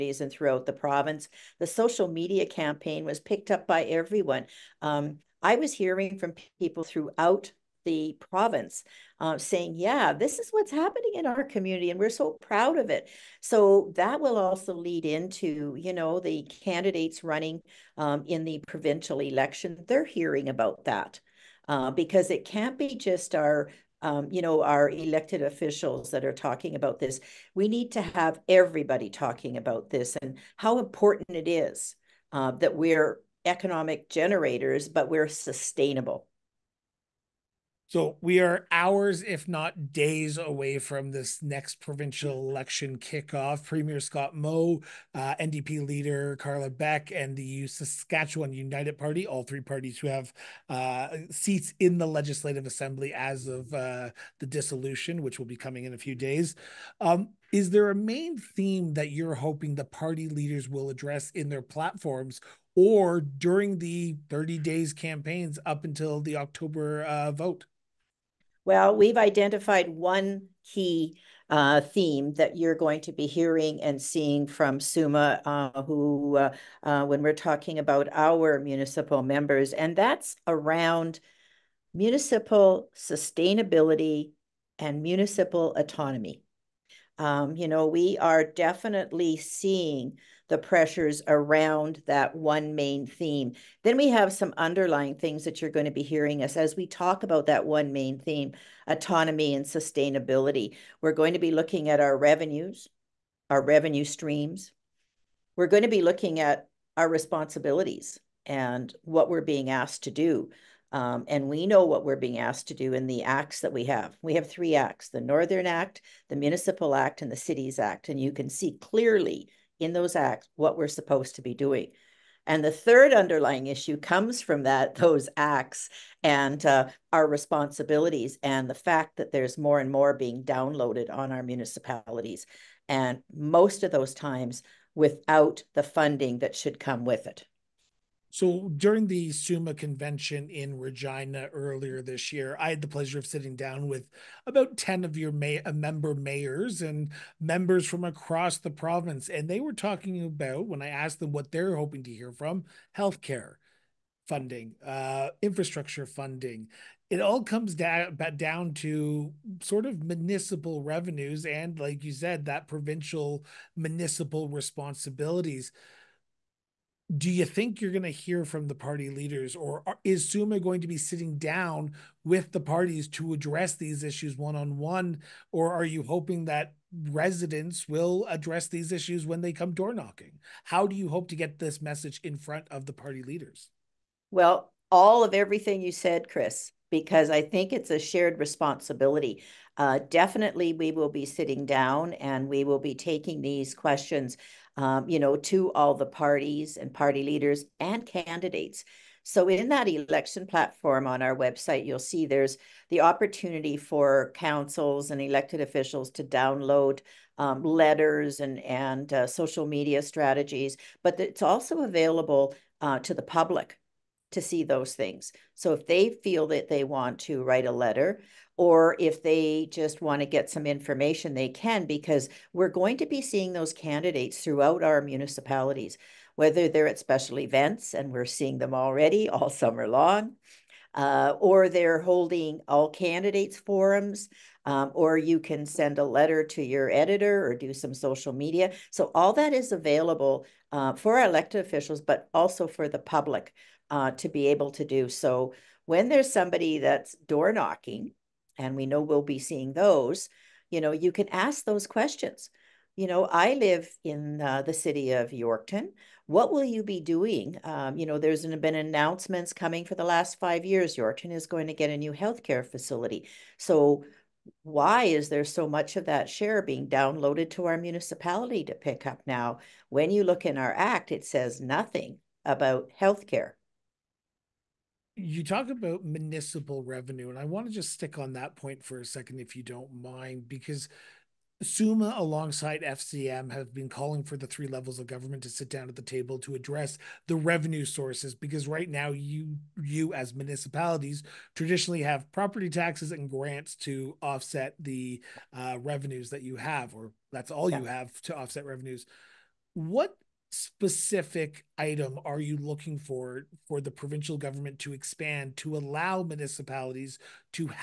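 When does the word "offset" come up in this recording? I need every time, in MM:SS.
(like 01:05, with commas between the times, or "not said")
04:54, 04:58.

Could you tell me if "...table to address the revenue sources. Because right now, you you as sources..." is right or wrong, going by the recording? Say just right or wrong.
wrong.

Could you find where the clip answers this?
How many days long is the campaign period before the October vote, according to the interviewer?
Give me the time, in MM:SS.
01:04.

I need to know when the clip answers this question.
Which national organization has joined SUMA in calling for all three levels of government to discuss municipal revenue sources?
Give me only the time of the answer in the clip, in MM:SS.
04:42.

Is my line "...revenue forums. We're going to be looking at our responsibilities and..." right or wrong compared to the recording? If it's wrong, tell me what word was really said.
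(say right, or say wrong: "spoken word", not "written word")
wrong: "streams", not "forums".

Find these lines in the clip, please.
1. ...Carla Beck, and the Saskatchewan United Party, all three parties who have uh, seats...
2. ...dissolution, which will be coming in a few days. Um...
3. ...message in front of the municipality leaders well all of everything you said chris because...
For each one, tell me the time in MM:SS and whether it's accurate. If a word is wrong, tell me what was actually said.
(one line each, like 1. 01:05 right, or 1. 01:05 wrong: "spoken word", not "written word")
1. 00:46 right
2. 00:54 right
3. 03:01 wrong: "party", not "municipality".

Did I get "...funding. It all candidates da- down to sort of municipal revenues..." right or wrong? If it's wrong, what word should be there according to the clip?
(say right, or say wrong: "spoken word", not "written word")
wrong: "comes", not "candidates".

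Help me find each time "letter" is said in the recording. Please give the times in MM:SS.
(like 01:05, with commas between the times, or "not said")
03:27, 03:37, 03:56.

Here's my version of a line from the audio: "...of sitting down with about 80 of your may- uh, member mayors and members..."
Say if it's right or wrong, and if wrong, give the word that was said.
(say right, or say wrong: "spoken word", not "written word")
wrong: "10", not "80".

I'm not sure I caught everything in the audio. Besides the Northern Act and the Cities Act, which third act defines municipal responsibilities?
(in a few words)
Municipal Act.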